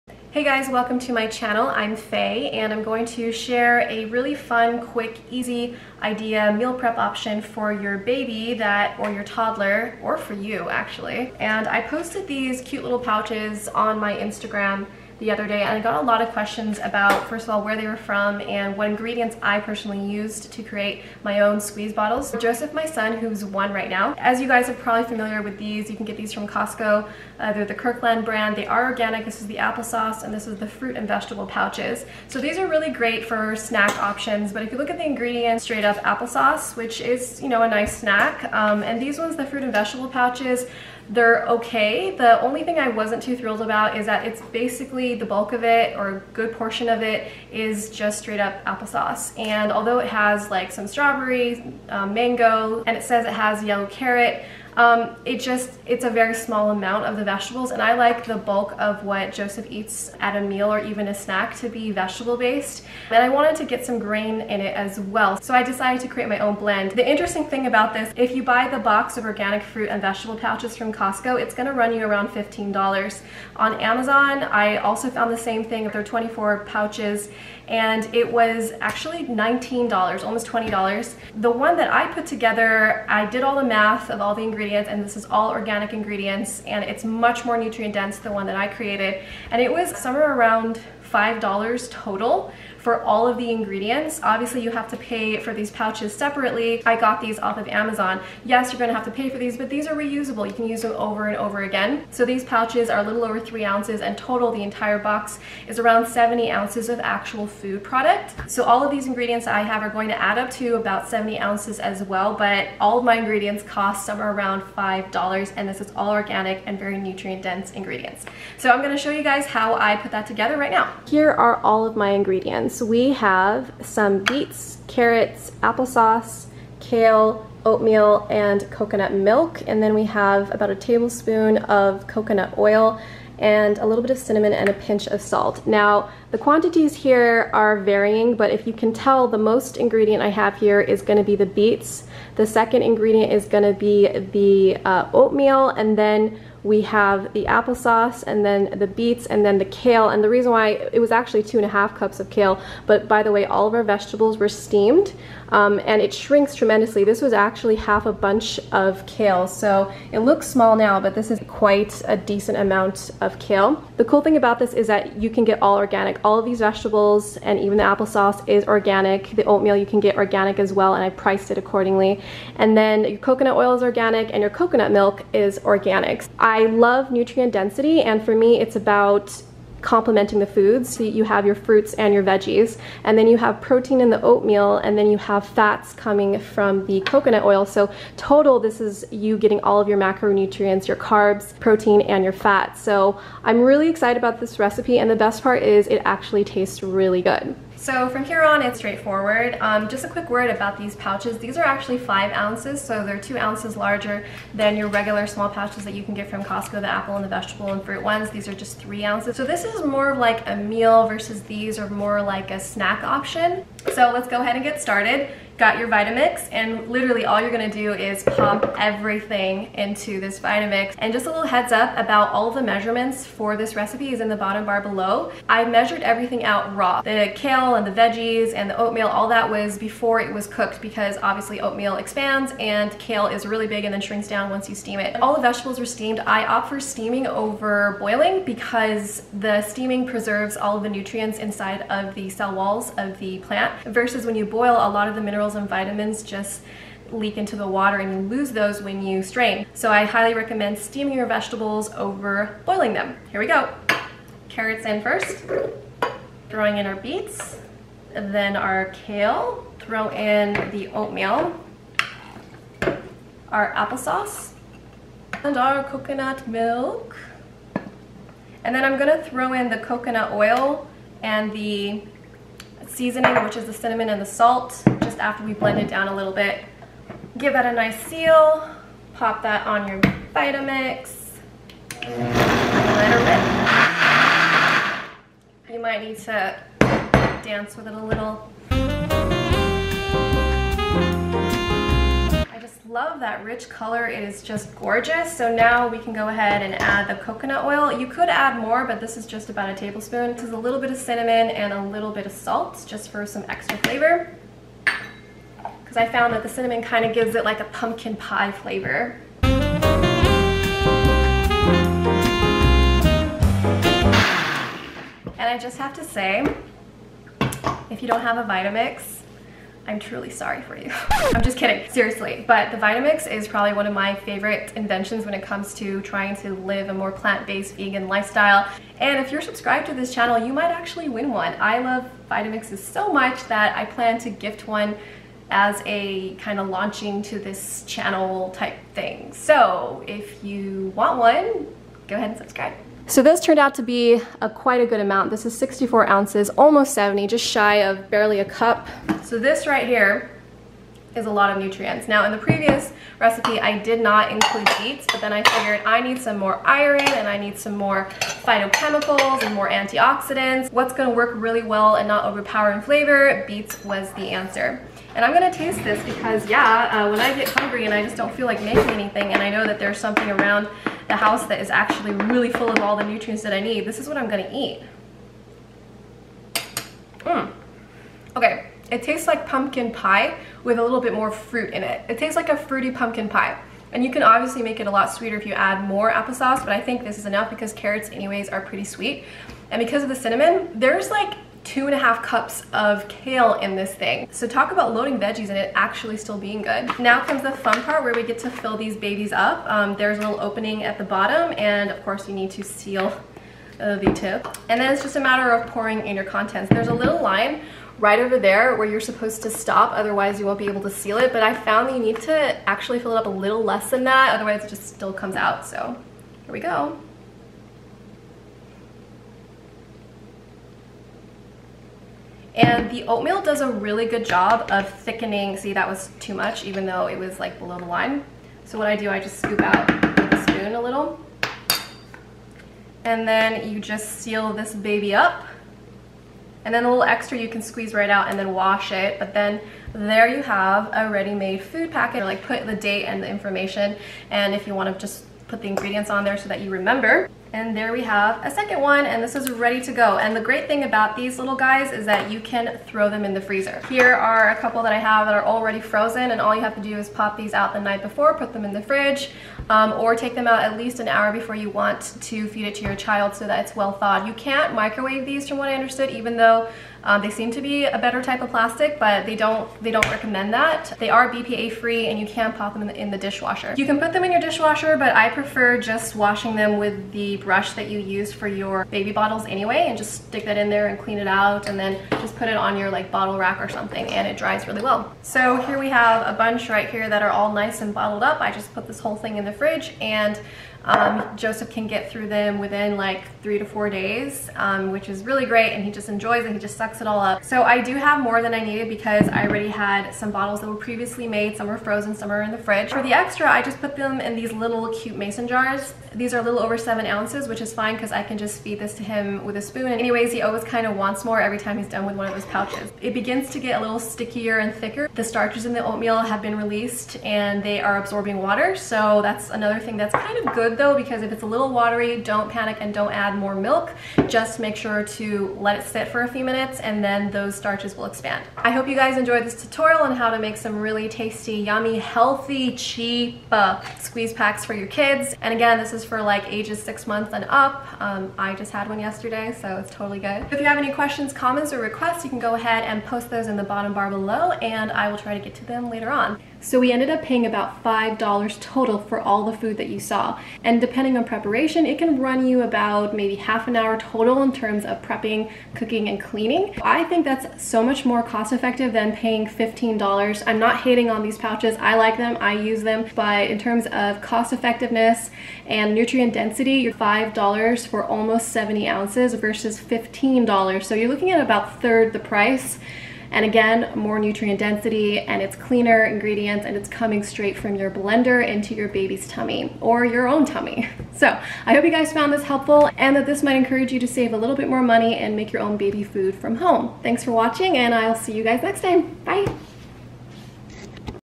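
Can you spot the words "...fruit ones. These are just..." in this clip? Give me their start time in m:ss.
3:27.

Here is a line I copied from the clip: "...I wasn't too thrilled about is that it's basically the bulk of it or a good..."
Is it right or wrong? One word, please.
right.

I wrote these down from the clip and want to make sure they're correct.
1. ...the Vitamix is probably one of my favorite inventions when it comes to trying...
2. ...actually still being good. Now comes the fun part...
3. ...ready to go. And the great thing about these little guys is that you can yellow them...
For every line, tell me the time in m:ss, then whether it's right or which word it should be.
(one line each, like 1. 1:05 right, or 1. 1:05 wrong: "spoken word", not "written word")
1. 5:22 right
2. 6:35 right
3. 7:29 wrong: "throw", not "yellow".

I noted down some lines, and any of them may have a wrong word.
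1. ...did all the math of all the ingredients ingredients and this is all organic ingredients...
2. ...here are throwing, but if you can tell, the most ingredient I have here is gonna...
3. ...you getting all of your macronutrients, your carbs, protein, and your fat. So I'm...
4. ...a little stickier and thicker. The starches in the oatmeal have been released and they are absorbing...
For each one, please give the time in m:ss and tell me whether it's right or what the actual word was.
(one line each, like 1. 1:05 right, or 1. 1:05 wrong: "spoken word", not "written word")
1. 1:23 right
2. 2:16 wrong: "varying", not "throwing"
3. 3:09 right
4. 8:33 right.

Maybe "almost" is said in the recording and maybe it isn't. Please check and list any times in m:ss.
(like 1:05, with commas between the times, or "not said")
1:20, 5:46, 9:28.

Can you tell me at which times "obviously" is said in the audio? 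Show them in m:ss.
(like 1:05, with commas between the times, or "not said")
1:34, 3:51, 6:24.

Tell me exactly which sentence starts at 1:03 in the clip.
And I wanted to get some grain in it as well.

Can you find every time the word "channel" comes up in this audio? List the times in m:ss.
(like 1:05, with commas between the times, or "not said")
0:01, 5:30, 5:37.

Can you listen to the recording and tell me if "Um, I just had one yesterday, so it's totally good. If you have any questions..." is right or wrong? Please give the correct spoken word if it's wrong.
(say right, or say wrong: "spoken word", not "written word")
right.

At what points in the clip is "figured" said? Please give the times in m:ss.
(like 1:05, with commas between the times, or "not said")
5:55.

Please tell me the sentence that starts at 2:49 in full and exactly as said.
The oatmeal you can get organic as well and I priced it accordingly.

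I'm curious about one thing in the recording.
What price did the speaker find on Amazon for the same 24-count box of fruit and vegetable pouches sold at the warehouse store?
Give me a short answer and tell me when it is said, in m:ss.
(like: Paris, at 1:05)
$19, at 1:19.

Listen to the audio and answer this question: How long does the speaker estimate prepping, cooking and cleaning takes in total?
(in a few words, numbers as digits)
half an hour.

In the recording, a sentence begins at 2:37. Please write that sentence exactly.
This was actually half a bunch of kale.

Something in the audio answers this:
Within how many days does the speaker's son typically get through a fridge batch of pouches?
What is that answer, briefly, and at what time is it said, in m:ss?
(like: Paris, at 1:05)
3 to 4 days, at 8:13.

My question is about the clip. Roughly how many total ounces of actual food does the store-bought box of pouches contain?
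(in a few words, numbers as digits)
70 ounces.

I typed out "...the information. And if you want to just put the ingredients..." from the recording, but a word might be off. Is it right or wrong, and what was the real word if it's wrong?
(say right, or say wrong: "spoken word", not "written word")
right.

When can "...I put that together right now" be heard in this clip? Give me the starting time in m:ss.
1:59.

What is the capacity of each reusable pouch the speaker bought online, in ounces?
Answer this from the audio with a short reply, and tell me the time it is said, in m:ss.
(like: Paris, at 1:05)
5 ounces, at 3:21.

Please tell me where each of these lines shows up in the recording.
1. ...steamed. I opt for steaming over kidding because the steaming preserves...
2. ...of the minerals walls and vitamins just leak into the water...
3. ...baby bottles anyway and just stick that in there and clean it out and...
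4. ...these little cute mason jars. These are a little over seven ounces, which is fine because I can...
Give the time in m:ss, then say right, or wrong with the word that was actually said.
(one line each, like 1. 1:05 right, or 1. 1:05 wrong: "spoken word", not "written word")
1. 3:55 wrong: "boiling", not "kidding"
2. 4:05 wrong: "minerals", not "walls"
3. 7:58 right
4. 8:24 right.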